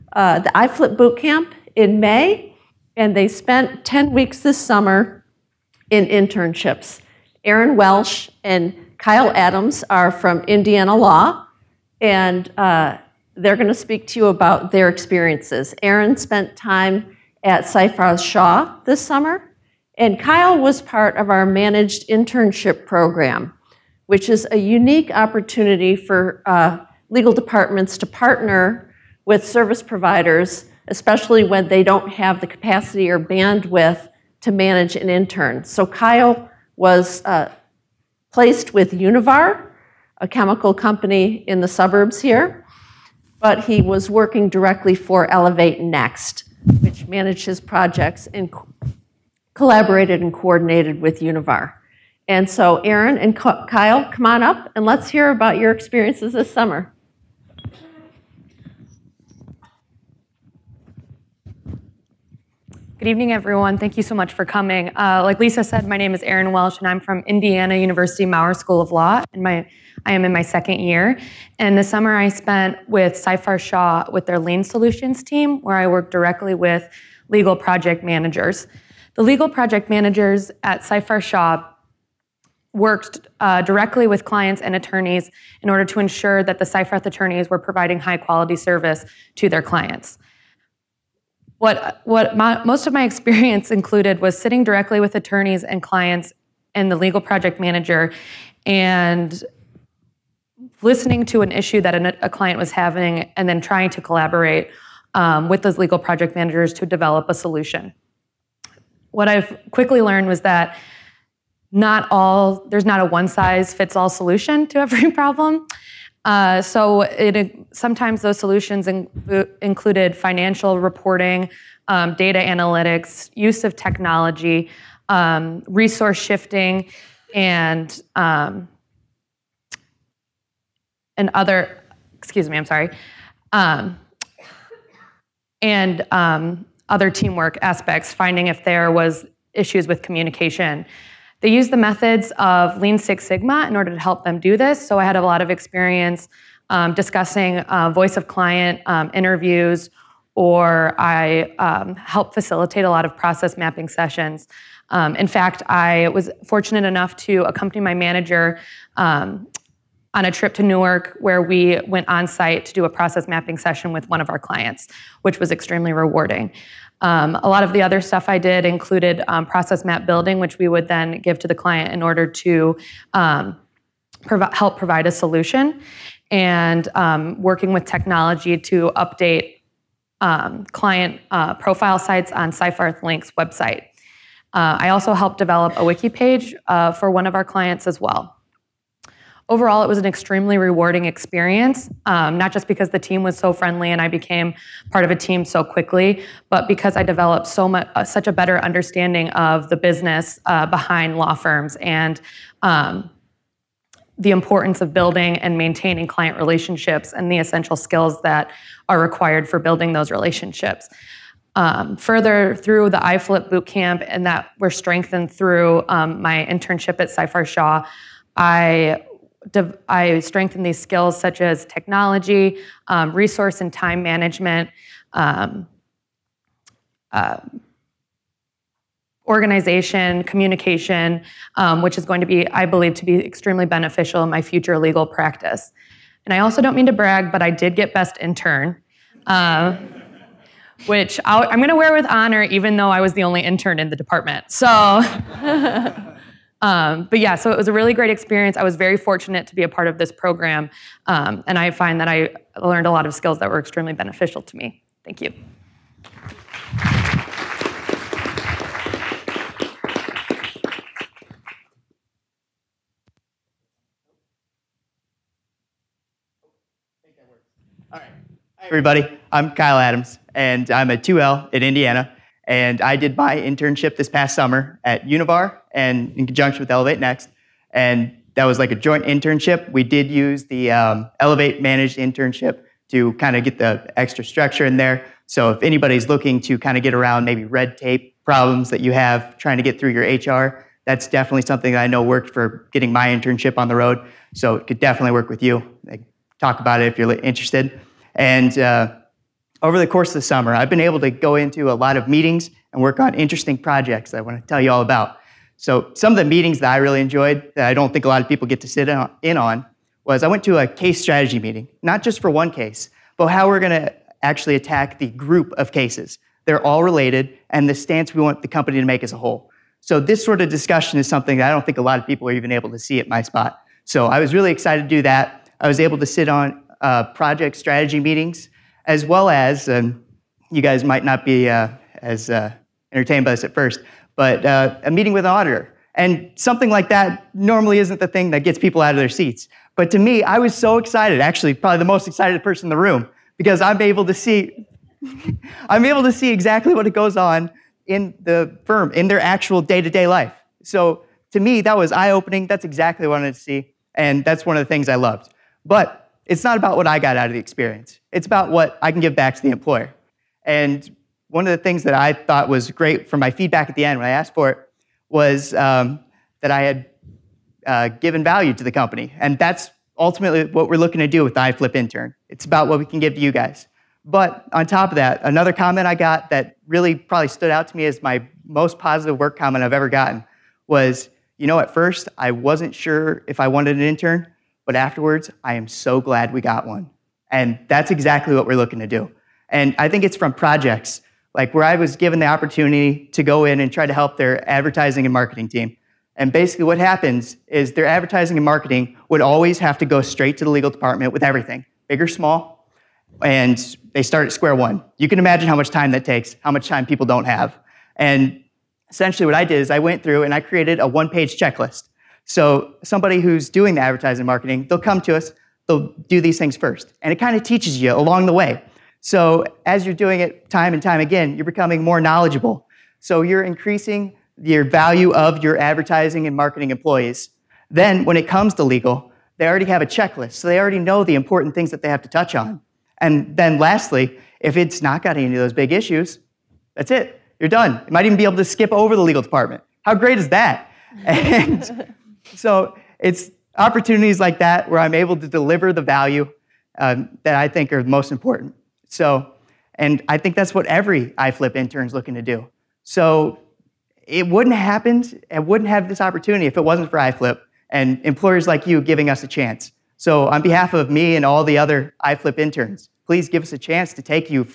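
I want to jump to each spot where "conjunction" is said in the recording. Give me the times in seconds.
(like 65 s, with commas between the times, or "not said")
276 s.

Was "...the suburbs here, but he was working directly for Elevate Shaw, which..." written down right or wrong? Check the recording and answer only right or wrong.
wrong.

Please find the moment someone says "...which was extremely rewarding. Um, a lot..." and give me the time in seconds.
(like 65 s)
165 s.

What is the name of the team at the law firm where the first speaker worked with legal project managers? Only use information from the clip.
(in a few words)
Lean Solutions.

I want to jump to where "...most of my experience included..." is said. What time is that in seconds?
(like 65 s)
92 s.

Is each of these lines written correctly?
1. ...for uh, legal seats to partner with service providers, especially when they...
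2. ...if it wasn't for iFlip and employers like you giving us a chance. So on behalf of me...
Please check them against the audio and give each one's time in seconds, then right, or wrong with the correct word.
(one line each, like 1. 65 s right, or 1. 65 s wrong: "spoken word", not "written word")
1. 25 s wrong: "departments", not "seats"
2. 456 s right.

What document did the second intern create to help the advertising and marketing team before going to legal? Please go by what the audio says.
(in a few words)
one page checklist.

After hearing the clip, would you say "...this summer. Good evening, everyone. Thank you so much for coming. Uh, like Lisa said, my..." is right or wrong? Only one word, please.
right.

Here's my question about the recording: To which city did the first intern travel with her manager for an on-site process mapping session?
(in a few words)
Newark.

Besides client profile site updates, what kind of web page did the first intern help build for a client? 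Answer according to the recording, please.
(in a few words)
wiki page.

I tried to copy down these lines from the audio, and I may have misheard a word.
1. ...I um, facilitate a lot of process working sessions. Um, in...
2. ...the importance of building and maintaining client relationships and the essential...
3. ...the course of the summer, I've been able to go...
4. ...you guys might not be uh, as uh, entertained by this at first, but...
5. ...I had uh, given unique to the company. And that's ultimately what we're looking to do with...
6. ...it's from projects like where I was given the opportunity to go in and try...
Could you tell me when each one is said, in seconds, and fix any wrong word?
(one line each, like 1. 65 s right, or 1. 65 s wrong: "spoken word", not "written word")
1. 150 s wrong: "mapping", not "working"
2. 204 s right
3. 299 s right
4. 329 s right
5. 366 s wrong: "value", not "unique"
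6. 390 s right.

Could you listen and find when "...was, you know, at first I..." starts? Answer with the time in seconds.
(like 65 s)
380 s.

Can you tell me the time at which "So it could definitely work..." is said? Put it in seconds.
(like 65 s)
294 s.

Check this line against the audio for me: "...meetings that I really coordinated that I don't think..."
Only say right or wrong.
wrong.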